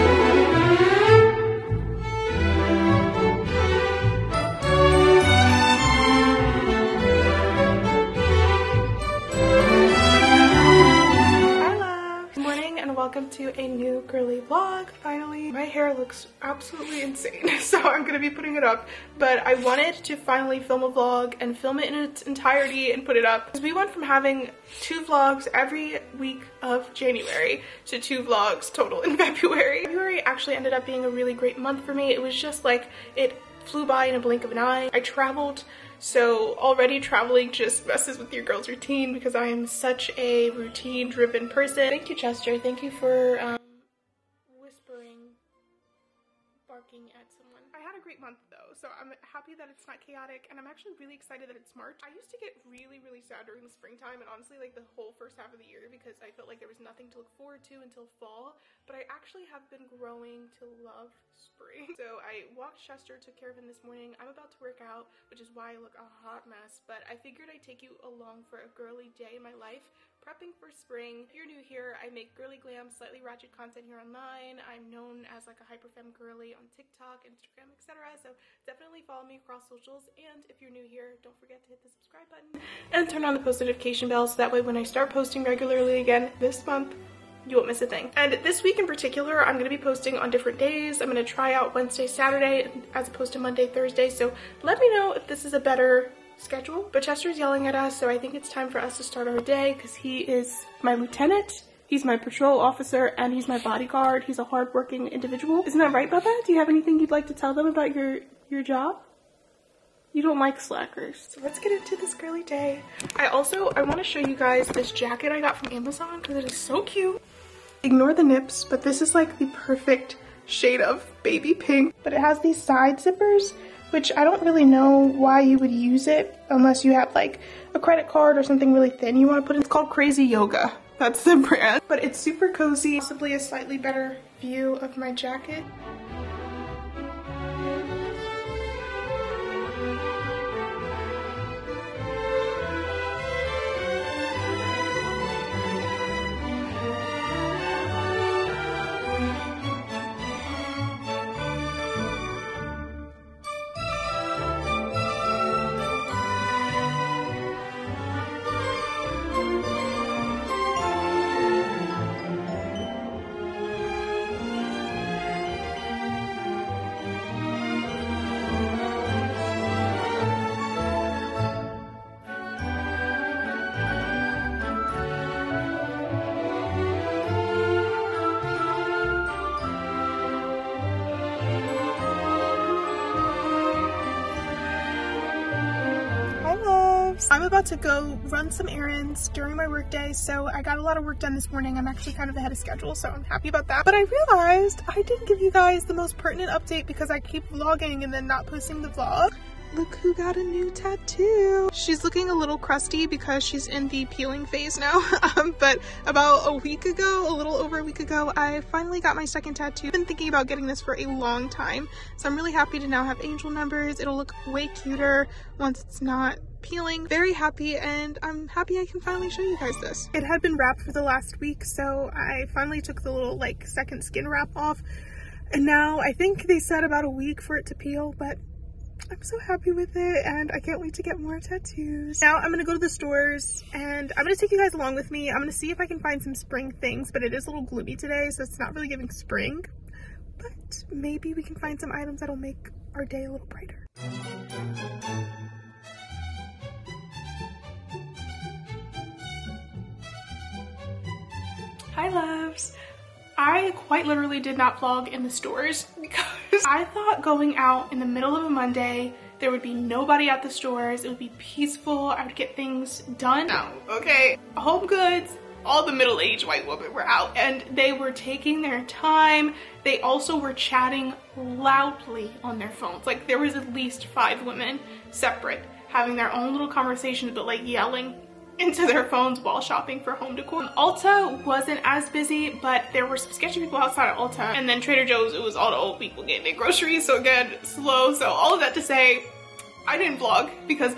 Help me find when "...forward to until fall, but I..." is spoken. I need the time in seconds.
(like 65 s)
57 s.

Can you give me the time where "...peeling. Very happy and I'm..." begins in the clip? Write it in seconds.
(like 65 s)
216 s.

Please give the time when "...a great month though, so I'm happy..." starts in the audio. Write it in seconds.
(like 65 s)
47 s.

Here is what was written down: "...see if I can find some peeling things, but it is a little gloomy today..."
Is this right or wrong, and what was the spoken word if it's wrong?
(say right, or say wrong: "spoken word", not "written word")
wrong: "spring", not "peeling".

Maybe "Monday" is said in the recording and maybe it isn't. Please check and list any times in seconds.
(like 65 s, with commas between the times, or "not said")
93 s, 258 s.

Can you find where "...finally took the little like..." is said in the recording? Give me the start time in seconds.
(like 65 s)
222 s.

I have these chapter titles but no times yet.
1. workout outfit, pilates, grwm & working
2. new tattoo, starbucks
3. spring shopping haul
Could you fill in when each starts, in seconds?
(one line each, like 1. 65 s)
1. 104 s
2. 184 s
3. 254 s.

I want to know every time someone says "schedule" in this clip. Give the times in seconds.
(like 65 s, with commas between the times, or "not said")
96 s, 192 s.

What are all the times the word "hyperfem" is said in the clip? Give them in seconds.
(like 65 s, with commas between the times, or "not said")
75 s.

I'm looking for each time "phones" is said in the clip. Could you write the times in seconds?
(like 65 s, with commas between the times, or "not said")
272 s, 279 s.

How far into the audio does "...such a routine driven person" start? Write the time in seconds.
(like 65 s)
39 s.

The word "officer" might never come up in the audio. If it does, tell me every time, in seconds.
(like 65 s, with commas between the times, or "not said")
102 s.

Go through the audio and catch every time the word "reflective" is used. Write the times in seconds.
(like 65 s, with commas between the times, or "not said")
not said.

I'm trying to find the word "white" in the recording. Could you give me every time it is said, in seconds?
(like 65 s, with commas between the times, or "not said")
266 s.